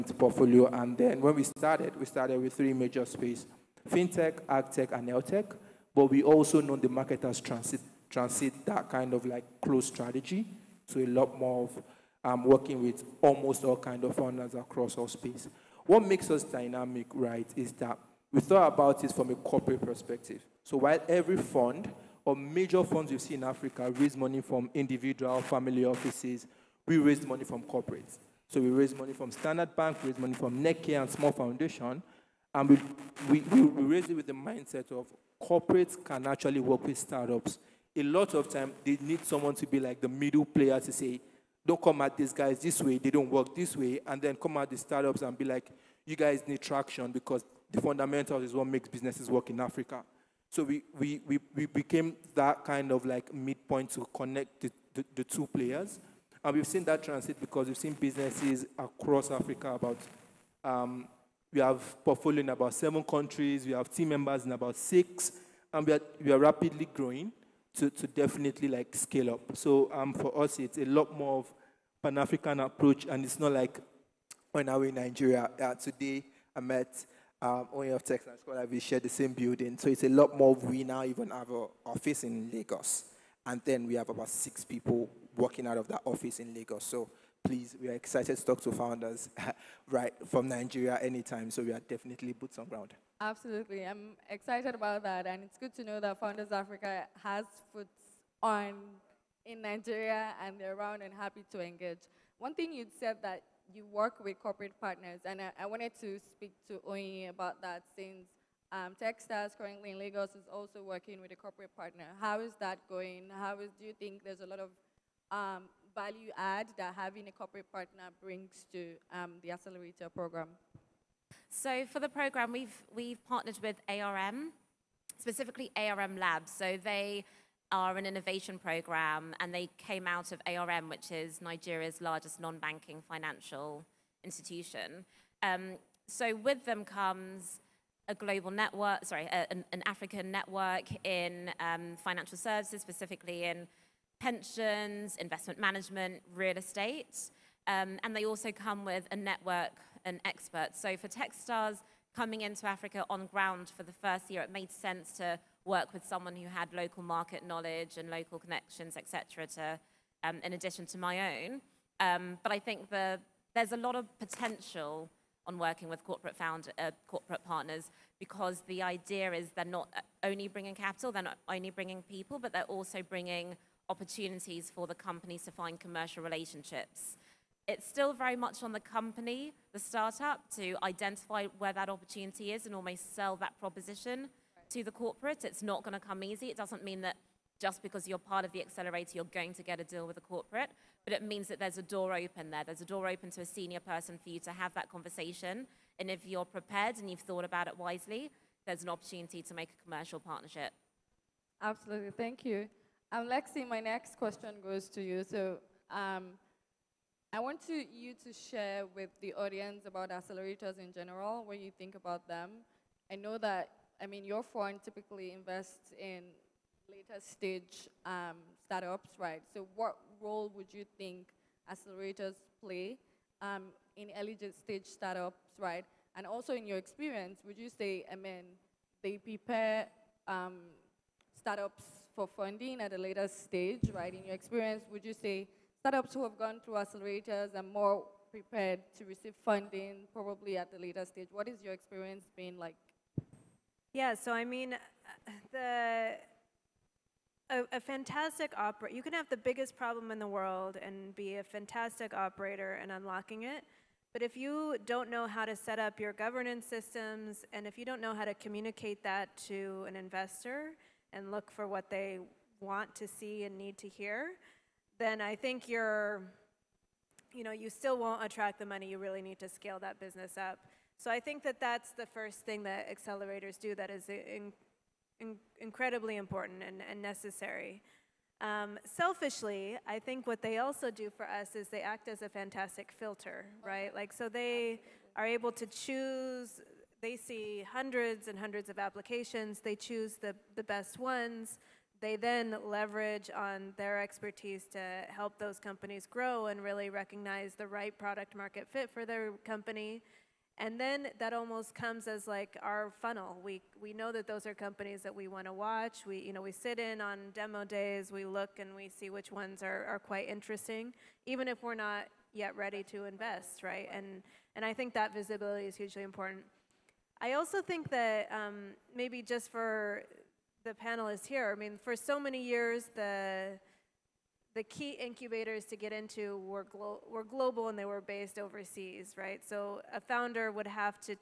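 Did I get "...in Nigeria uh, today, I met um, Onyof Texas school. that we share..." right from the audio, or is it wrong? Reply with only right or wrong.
right.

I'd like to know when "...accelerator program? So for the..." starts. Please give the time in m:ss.
1:59.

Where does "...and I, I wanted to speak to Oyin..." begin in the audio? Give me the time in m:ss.
1:45.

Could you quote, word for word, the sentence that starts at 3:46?
And also in your experience, would you say, I mean, they prepare um, startups for funding at a later stage, right?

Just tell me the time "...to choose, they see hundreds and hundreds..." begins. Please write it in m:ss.
4:45.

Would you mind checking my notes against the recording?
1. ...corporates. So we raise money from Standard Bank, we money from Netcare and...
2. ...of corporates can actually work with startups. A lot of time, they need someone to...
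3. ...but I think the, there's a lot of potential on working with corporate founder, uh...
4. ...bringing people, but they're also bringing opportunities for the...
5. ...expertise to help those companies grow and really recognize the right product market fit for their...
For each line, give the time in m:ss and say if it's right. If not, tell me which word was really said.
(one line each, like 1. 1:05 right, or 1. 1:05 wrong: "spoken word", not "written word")
1. 0:27 right
2. 0:34 right
3. 2:42 right
4. 2:51 right
5. 4:54 right.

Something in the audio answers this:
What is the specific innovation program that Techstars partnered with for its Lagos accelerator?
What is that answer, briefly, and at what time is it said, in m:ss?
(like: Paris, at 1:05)
ARM Labs, at 2:05.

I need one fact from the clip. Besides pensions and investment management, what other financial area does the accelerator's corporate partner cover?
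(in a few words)
real estate.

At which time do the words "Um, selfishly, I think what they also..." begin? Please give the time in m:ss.
4:38.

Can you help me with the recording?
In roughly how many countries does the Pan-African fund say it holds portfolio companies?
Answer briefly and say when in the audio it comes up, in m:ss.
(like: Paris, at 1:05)
7, at 1:02.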